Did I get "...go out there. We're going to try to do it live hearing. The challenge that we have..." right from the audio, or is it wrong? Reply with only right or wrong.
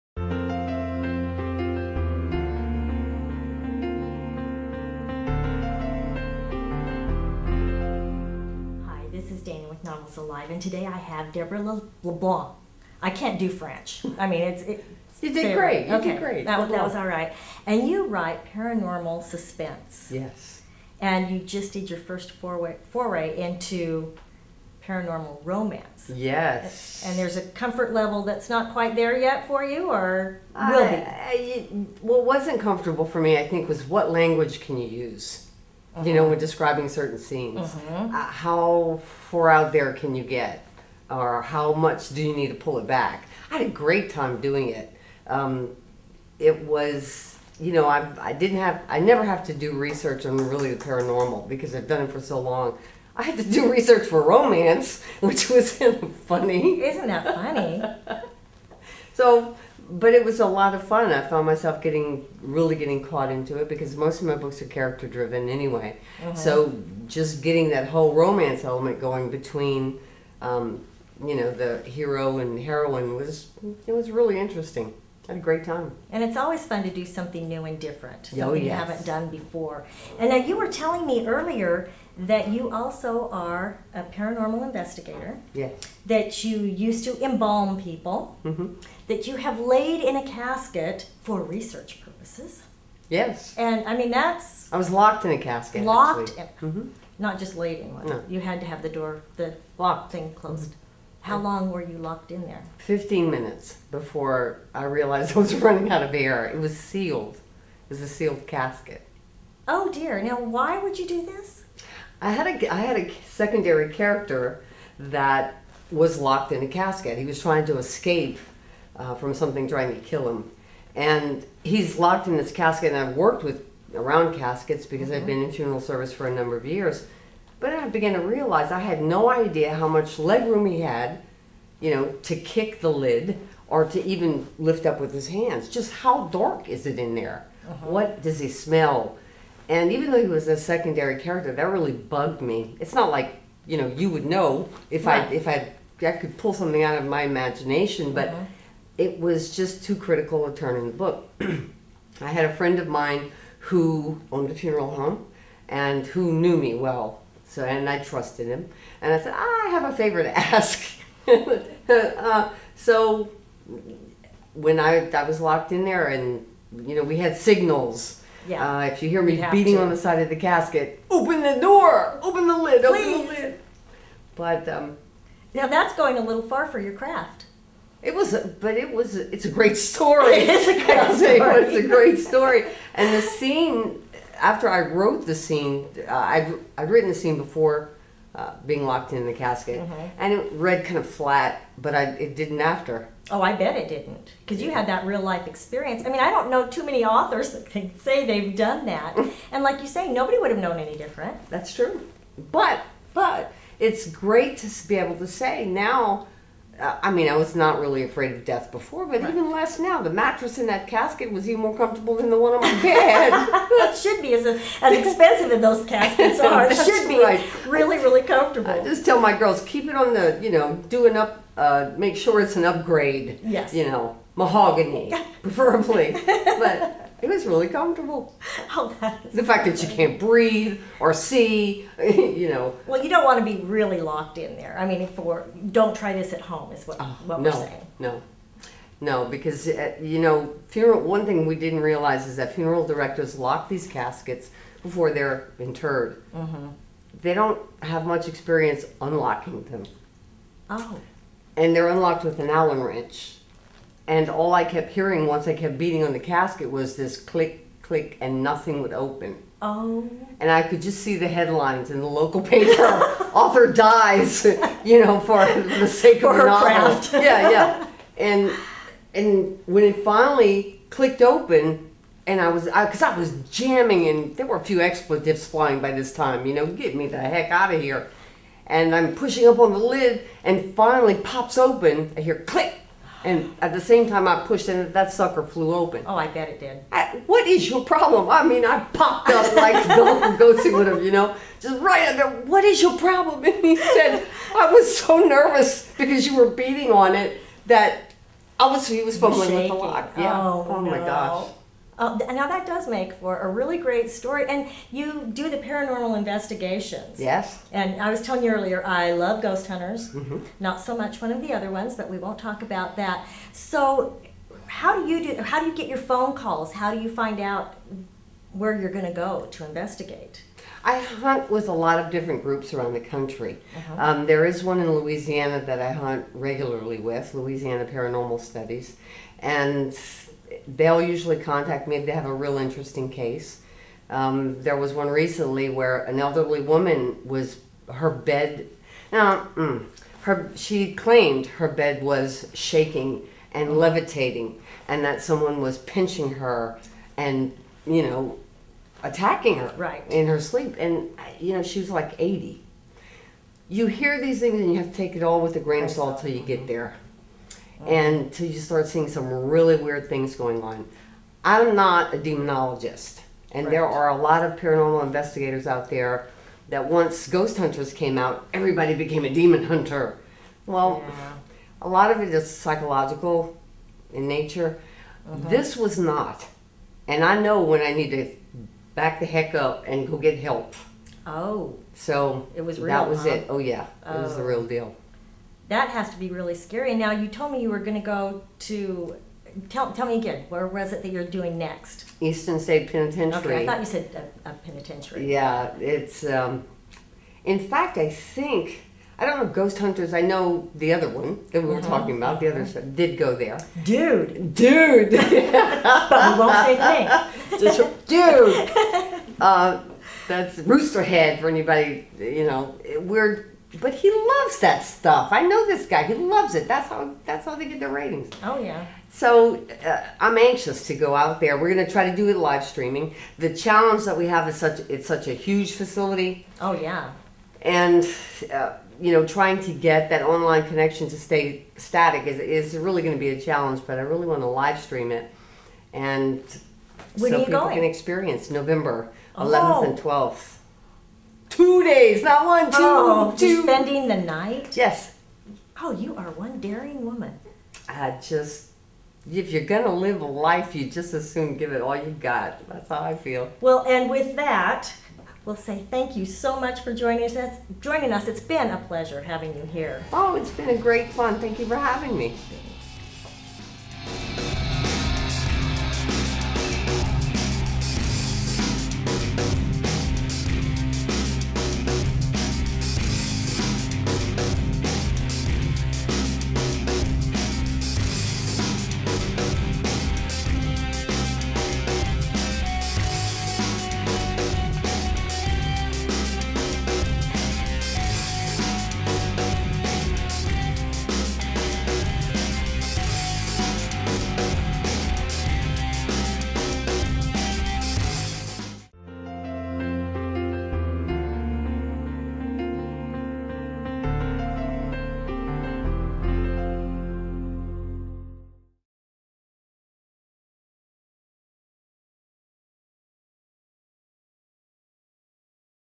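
wrong.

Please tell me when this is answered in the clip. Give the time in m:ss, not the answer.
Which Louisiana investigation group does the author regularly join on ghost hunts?
5:27.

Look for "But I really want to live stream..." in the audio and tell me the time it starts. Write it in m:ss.
7:13.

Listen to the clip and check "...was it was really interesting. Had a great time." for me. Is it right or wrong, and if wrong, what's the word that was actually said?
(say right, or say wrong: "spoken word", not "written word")
right.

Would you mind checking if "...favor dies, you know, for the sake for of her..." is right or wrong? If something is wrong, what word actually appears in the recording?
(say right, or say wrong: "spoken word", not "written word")
wrong: "author", not "favor".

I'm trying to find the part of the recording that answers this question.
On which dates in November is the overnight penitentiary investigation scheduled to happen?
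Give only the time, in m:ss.
7:18.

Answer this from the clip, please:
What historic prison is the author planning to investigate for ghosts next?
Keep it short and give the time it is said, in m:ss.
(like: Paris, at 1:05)
Eastern State Penitentiary, at 6:32.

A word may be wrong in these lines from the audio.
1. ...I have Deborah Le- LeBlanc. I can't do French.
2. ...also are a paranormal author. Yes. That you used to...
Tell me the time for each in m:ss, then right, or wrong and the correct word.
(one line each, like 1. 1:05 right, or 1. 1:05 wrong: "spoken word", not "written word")
1. 0:10 right
2. 1:22 wrong: "investigator", not "author".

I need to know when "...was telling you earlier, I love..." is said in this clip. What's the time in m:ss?
5:08.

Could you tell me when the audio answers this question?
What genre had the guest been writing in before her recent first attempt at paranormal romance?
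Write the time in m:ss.
0:18.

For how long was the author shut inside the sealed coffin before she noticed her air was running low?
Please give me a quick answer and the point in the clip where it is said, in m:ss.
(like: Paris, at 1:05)
15 minutes, at 1:42.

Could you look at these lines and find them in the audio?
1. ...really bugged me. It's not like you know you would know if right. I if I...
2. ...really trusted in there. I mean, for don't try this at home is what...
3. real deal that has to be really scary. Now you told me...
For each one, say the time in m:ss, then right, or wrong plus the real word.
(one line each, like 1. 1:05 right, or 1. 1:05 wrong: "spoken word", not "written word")
1. 2:21 right
2. 3:53 wrong: "locked", not "trusted"
3. 6:24 right.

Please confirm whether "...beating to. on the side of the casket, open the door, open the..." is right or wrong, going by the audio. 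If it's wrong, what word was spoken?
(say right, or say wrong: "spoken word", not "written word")
right.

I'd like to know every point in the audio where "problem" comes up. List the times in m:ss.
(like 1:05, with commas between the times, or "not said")
4:47, 4:52.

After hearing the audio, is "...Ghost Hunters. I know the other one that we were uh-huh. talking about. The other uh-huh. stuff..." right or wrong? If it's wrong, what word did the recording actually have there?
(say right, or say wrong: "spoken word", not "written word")
right.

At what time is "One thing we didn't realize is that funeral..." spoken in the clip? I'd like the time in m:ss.
4:01.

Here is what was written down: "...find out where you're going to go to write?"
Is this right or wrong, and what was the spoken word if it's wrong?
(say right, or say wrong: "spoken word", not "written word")
wrong: "investigate", not "write".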